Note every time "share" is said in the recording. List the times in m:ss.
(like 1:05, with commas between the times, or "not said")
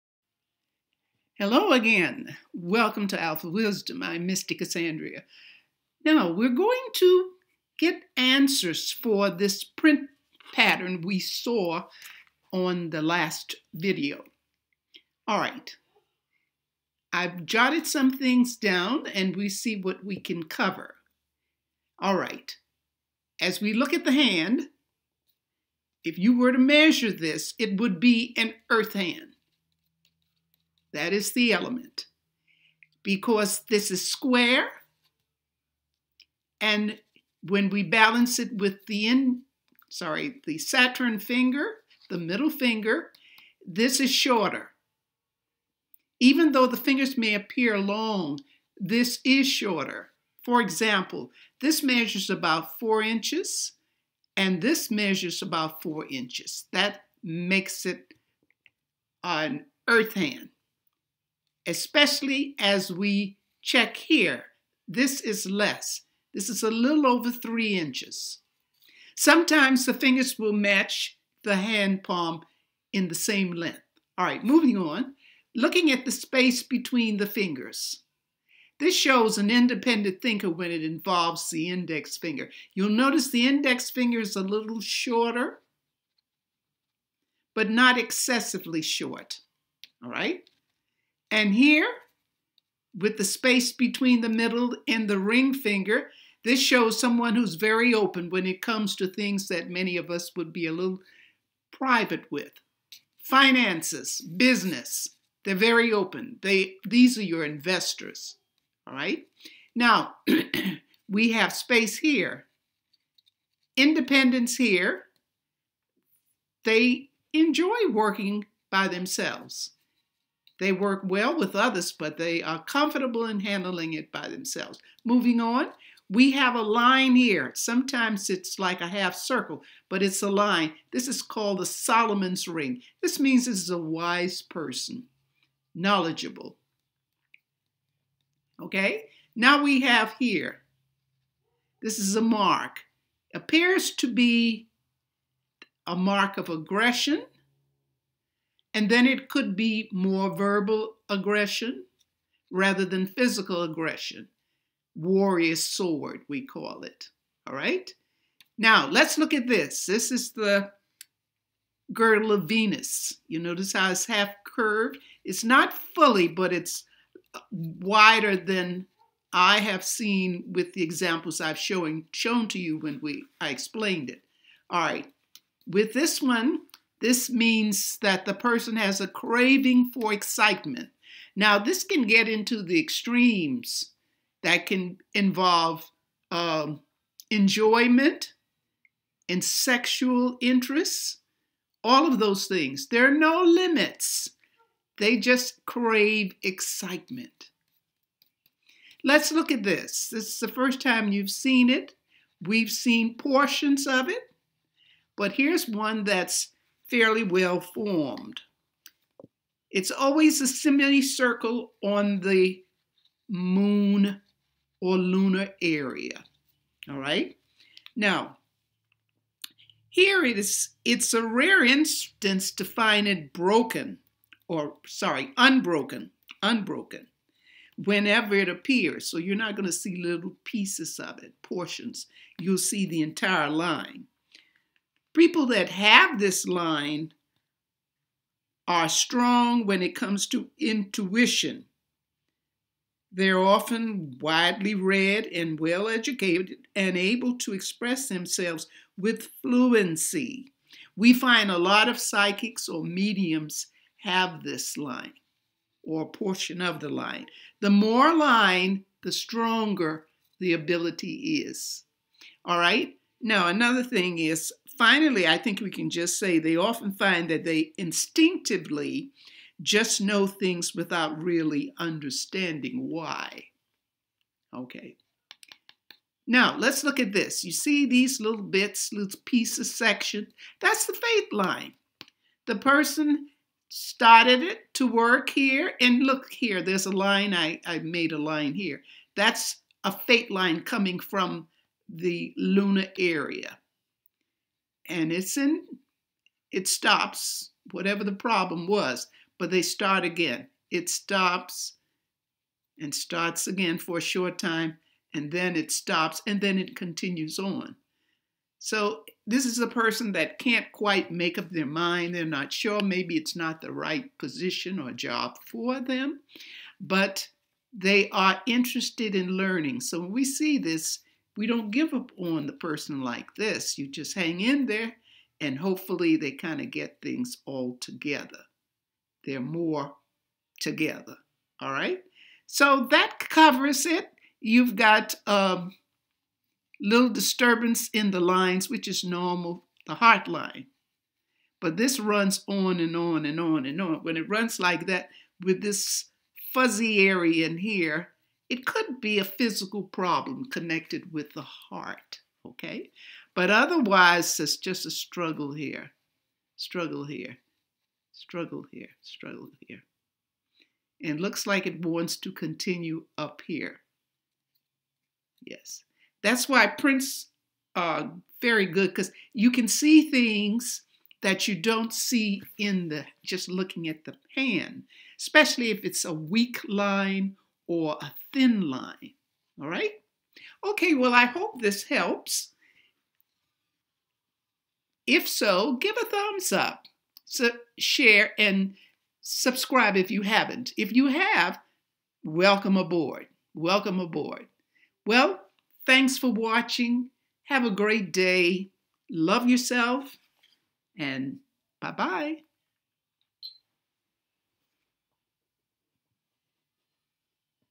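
6:27.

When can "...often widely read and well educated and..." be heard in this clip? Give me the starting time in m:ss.
4:03.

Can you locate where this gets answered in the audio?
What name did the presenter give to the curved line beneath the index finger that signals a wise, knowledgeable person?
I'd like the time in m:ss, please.
2:11.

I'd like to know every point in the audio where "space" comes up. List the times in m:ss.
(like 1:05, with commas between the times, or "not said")
1:16, 1:33, 1:51.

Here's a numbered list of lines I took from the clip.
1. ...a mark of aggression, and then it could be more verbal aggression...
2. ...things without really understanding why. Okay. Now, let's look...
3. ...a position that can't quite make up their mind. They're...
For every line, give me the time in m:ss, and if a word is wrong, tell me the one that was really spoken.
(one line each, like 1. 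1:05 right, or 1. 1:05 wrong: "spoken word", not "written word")
1. 2:25 right
2. 4:30 right
3. 5:09 wrong: "person", not "position".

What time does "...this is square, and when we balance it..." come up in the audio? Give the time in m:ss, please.
0:33.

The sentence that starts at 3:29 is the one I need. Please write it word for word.
It's always a semicircle on the moon or lunar area.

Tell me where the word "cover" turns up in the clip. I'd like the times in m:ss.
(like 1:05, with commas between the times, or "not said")
0:20, 5:33.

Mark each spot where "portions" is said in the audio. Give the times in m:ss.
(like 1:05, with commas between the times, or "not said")
3:23, 3:51, 4:16.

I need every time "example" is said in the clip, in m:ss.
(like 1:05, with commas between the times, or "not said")
0:50, 2:50.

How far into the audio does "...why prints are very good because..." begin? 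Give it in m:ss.
6:06.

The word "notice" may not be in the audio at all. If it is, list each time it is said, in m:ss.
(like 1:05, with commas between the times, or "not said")
1:22, 2:43.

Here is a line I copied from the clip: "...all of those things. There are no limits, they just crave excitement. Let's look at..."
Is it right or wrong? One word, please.
right.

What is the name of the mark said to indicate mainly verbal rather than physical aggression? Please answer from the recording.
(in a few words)
Warrior sword.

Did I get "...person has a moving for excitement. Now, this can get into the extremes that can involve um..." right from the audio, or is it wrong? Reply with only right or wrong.
wrong.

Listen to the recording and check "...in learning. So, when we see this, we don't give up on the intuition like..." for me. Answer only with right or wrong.
wrong.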